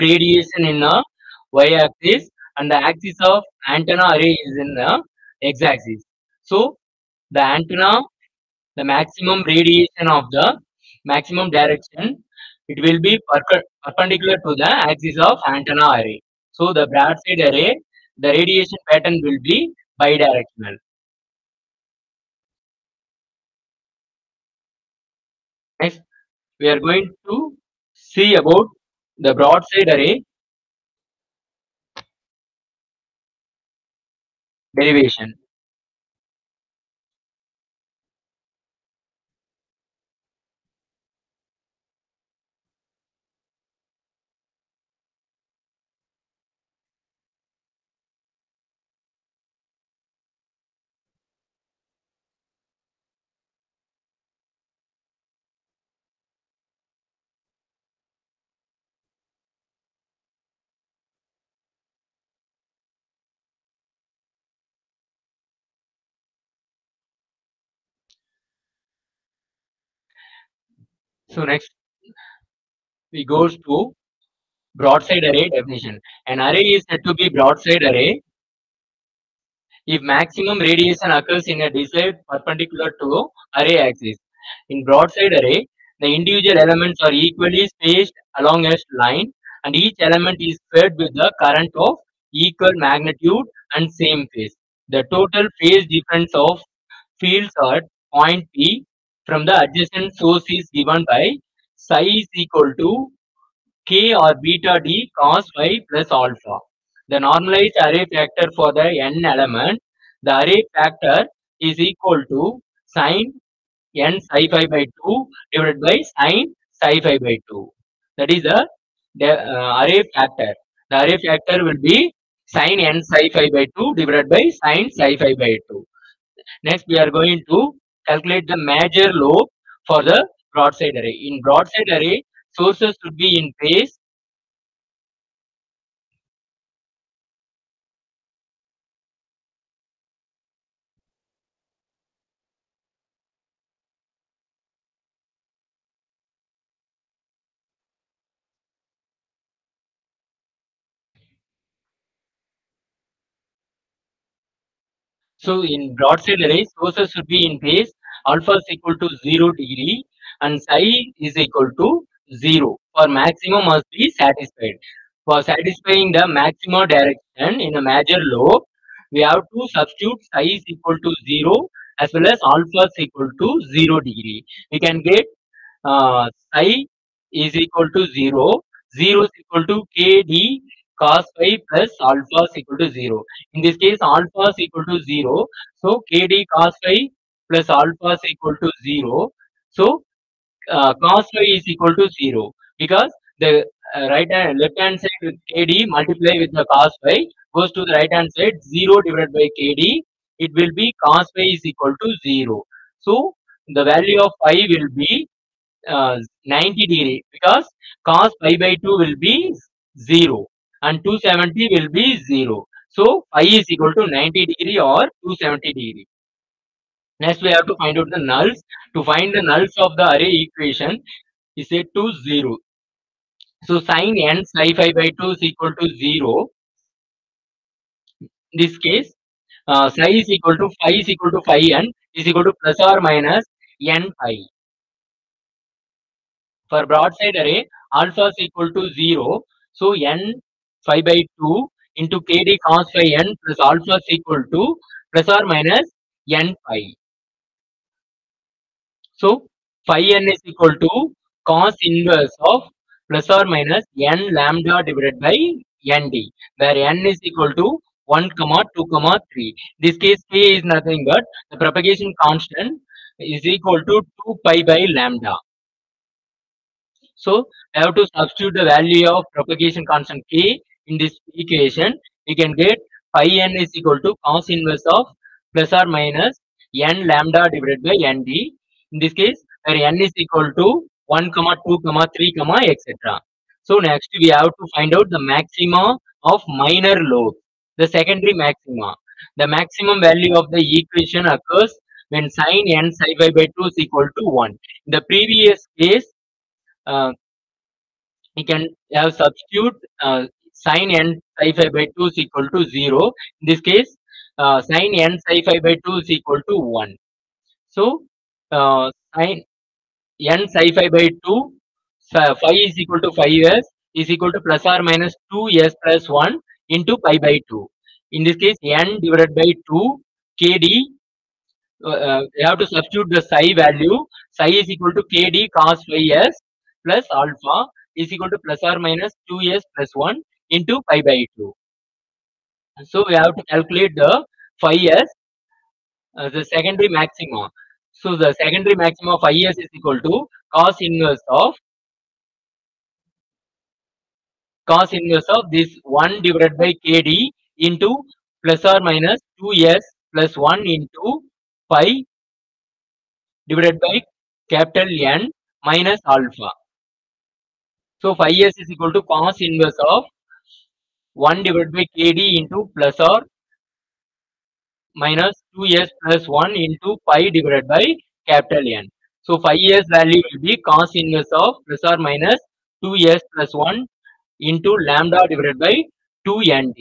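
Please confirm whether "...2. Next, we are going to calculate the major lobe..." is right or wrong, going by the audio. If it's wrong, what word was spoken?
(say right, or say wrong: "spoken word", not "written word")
right.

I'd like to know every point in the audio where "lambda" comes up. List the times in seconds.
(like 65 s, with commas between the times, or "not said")
254 s, 264 s, 277 s, 374 s.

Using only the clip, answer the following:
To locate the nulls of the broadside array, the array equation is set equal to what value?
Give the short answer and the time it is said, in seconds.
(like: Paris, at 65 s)
0, at 221 s.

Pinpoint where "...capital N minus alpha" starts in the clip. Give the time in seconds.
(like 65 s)
354 s.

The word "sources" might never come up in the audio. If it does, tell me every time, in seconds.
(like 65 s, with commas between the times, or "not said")
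100 s, 132 s, 156 s.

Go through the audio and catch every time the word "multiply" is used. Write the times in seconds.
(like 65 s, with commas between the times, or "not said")
195 s.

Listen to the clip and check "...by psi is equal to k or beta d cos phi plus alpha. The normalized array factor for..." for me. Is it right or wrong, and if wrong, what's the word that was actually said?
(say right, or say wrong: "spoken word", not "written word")
right.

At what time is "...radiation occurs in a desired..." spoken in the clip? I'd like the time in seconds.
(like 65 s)
80 s.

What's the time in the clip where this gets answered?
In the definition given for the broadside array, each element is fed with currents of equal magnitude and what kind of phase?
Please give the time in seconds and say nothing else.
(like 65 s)
93 s.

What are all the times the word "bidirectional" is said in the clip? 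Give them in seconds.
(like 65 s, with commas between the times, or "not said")
20 s.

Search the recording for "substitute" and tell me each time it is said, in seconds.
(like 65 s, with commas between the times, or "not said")
169 s, 268 s, 299 s, 322 s.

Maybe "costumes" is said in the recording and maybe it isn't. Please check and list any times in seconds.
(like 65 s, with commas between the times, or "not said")
not said.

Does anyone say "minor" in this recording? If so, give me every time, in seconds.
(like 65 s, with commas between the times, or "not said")
286 s.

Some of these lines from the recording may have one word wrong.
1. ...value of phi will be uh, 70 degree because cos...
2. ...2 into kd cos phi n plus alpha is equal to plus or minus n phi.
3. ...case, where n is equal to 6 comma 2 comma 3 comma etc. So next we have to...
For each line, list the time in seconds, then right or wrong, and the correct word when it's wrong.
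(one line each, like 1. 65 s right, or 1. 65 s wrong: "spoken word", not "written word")
1. 203 s wrong: "90", not "70"
2. 241 s right
3. 279 s wrong: "1", not "6".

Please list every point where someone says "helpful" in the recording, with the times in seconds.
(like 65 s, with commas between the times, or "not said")
not said.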